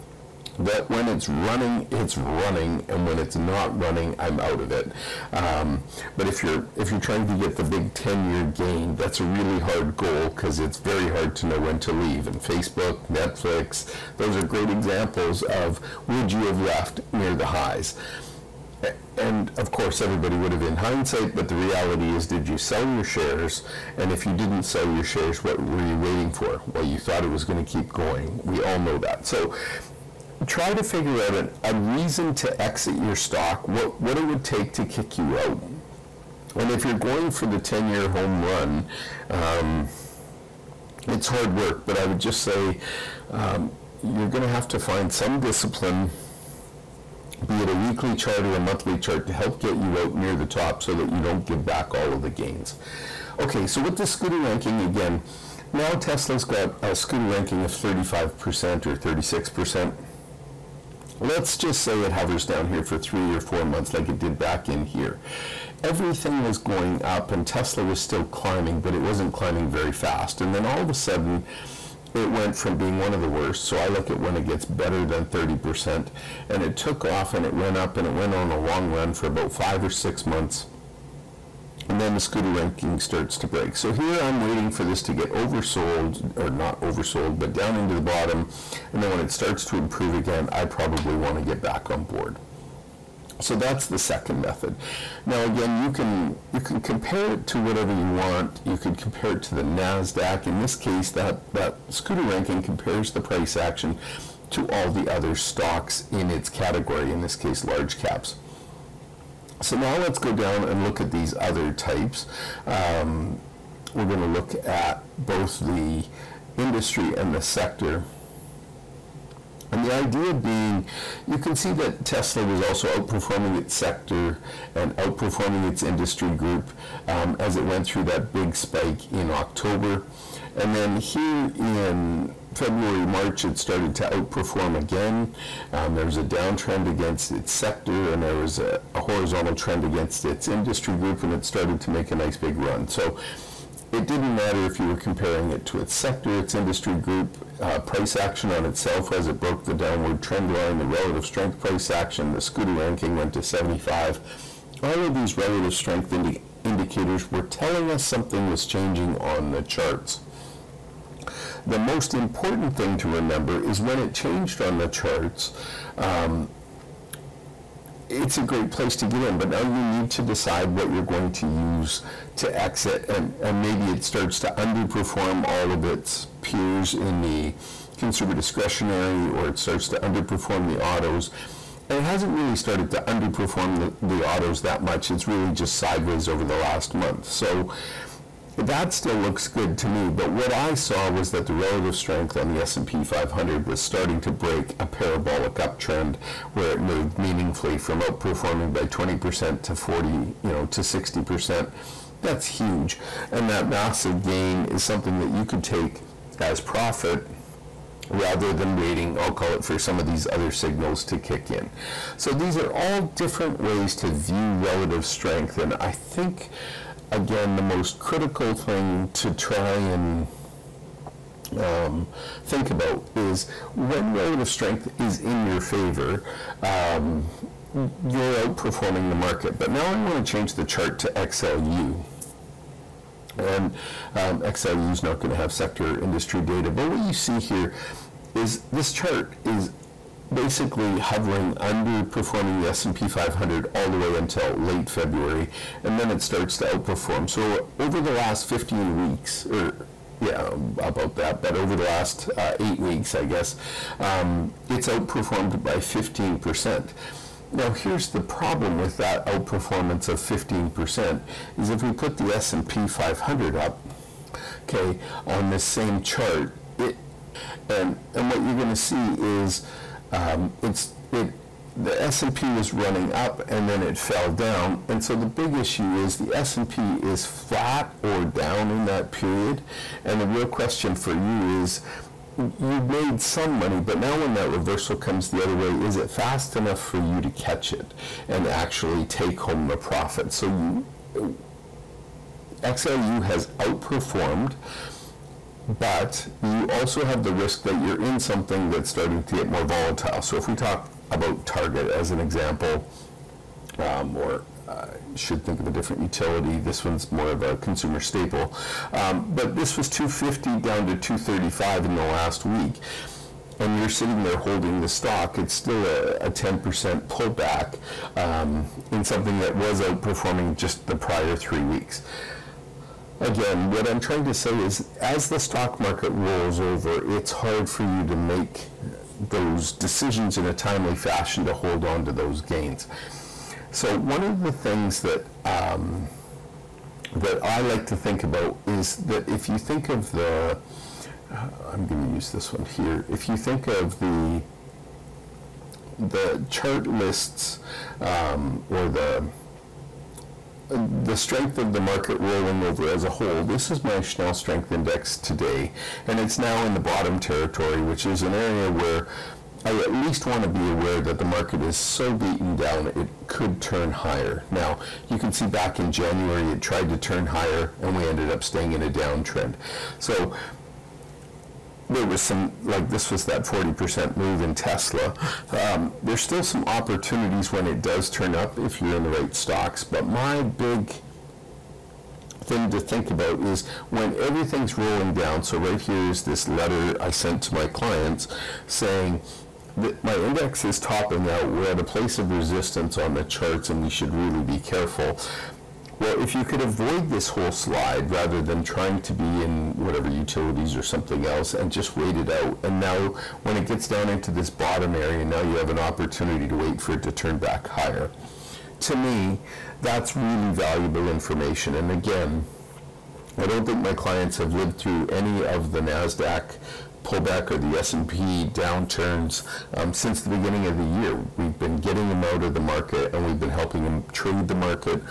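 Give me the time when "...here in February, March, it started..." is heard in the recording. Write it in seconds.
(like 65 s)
130 s.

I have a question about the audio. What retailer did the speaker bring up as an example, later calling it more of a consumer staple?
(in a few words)
Target.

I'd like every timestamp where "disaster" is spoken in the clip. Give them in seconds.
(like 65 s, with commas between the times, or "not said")
not said.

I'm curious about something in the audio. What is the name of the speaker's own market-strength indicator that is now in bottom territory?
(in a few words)
Schnell Strength Index.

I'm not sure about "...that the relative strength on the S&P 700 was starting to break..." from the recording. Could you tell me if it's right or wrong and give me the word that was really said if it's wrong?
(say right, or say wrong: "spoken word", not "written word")
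wrong: "500", not "700".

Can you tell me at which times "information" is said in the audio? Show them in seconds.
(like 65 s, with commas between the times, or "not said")
411 s.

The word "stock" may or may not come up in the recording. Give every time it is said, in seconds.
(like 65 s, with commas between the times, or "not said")
33 s, 105 s, 314 s, 325 s, 379 s.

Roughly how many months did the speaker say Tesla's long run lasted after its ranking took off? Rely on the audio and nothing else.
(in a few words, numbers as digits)
5 or 6 months.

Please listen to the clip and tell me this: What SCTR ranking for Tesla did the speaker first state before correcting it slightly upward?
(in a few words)
35%.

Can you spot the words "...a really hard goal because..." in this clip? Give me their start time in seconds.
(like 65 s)
9 s.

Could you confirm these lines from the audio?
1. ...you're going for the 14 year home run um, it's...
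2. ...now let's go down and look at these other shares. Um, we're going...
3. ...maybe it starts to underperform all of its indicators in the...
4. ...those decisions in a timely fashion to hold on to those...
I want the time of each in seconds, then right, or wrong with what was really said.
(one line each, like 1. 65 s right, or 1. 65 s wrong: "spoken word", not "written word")
1. 36 s wrong: "10", not "14"
2. 109 s wrong: "types", not "shares"
3. 173 s wrong: "peers", not "indicators"
4. 329 s right.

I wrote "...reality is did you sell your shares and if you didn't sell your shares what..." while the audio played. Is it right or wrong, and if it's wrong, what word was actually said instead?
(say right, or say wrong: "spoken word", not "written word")
right.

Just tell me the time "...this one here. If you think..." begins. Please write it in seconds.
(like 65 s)
342 s.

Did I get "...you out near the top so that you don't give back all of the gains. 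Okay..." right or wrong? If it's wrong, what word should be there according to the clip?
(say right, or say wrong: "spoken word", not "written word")
right.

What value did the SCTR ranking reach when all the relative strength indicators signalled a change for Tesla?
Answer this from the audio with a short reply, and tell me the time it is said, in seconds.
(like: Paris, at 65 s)
75, at 153 s.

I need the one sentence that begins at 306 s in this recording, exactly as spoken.
This one's more of a consumer staple.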